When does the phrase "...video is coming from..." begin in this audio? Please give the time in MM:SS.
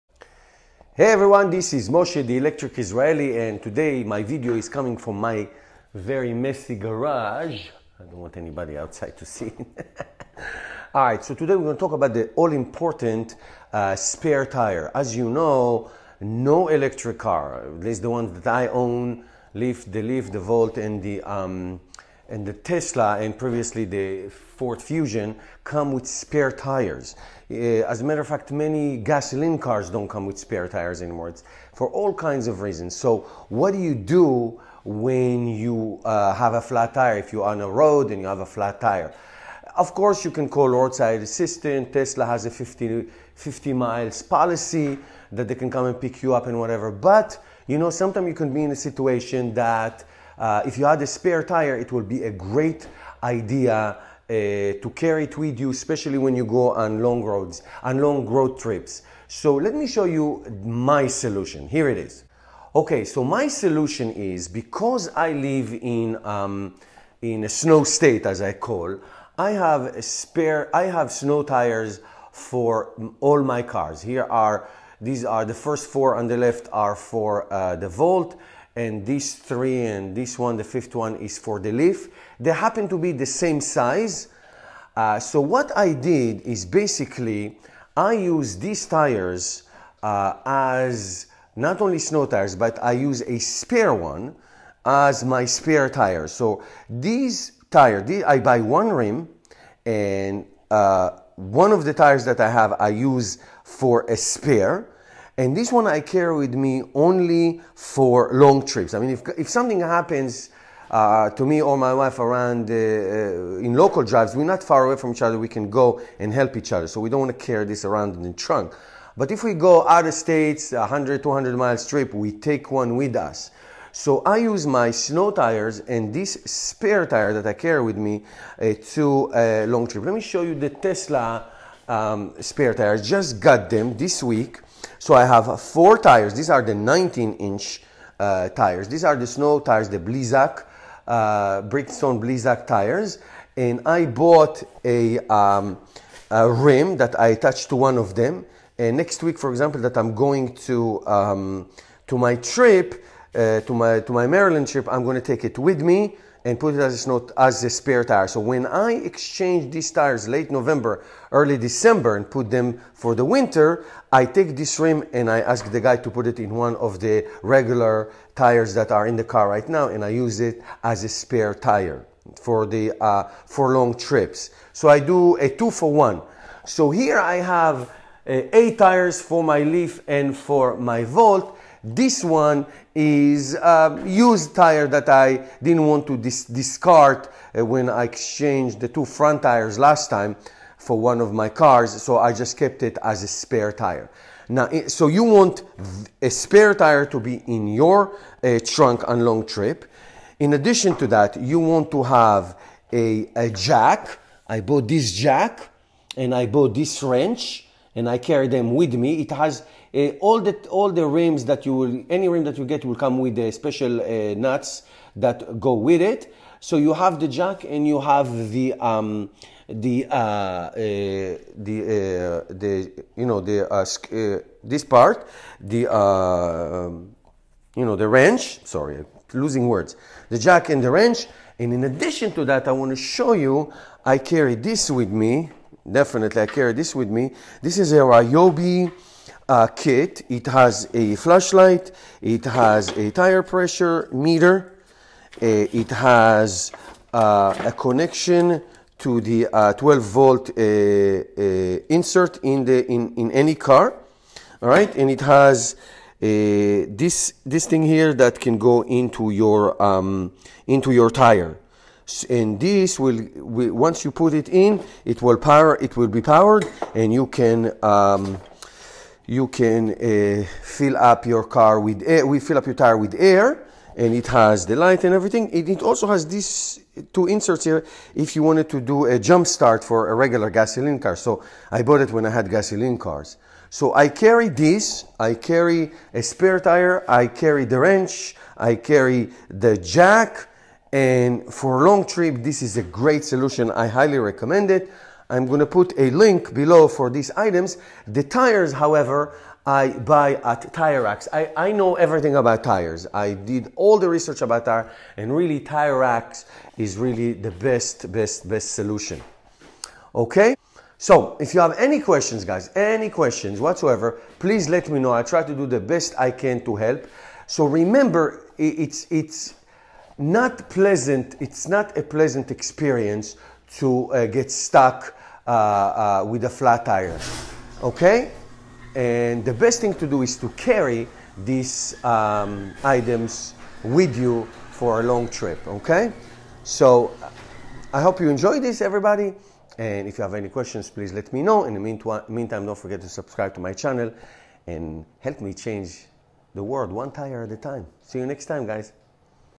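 00:04.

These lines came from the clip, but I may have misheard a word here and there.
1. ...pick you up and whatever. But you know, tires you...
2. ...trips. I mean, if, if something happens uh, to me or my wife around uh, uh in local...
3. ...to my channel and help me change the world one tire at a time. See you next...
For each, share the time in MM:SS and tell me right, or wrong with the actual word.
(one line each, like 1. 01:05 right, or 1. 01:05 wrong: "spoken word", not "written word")
1. 00:45 wrong: "sometimes", not "tires"
2. 01:48 right
3. 05:43 right.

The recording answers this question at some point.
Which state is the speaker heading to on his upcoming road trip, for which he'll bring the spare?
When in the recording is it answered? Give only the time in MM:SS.
02:34.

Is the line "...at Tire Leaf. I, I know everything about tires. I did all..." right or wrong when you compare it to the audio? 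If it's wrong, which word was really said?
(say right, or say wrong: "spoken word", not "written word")
wrong: "Racks", not "Leaf".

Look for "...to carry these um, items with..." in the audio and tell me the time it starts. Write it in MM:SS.
05:30.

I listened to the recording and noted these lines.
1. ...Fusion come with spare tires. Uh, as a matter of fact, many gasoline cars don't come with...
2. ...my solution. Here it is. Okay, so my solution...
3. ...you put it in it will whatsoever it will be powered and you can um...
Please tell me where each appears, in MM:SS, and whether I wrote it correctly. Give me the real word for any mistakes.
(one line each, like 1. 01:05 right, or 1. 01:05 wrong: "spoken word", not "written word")
1. 00:24 right
2. 01:00 right
3. 04:24 wrong: "power", not "whatsoever".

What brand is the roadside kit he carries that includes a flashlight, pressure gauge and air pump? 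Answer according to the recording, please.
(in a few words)
Ryobi.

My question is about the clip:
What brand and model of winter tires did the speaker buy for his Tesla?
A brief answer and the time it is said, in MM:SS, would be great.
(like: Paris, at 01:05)
Bridgestone Blizzak, at 02:21.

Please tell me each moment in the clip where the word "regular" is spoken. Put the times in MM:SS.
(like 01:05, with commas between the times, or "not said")
02:47, 04:40.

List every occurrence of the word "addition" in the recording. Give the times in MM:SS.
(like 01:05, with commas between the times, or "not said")
03:20, 03:51.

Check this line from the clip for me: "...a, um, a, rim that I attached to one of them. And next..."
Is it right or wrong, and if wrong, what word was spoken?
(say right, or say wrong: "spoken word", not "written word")
right.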